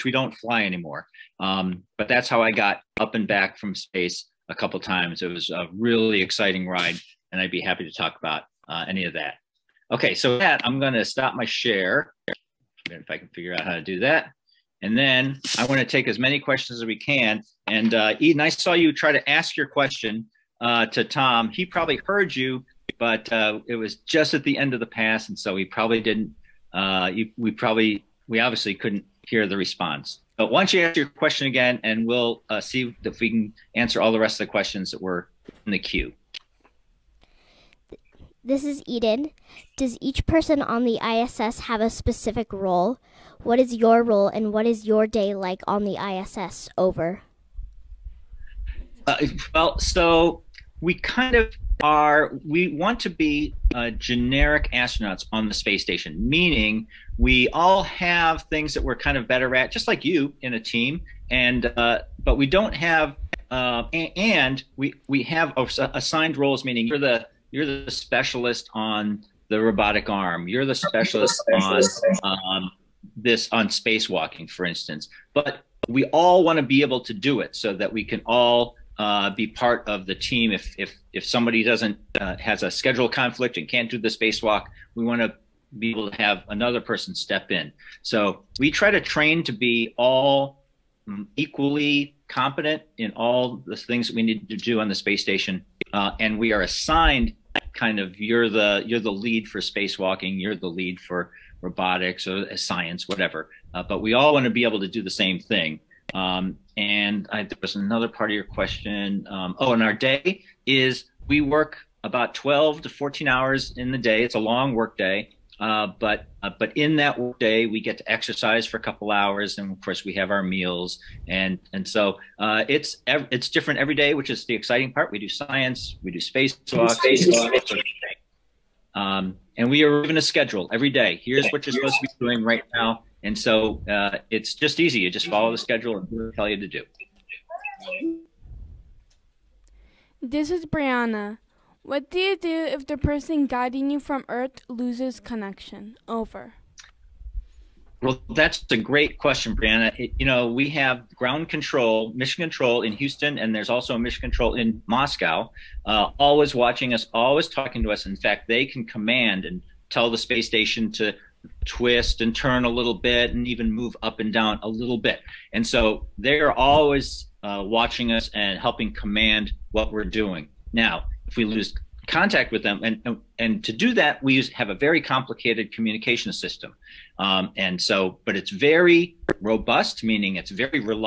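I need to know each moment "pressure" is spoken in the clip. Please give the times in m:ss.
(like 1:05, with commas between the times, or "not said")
not said.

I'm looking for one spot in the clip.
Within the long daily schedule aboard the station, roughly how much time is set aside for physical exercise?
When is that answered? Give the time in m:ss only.
1:58.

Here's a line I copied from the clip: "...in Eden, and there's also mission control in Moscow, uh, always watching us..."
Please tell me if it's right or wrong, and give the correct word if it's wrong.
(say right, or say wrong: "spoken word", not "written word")
wrong: "Houston", not "Eden".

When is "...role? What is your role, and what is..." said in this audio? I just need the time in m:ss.
0:42.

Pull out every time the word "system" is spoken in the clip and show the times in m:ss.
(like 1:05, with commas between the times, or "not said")
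2:56.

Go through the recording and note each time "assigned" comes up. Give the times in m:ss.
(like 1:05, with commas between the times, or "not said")
1:05, 1:36.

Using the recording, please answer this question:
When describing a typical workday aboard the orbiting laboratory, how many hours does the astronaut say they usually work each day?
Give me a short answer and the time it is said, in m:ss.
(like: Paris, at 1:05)
12 to 14 hours, at 1:52.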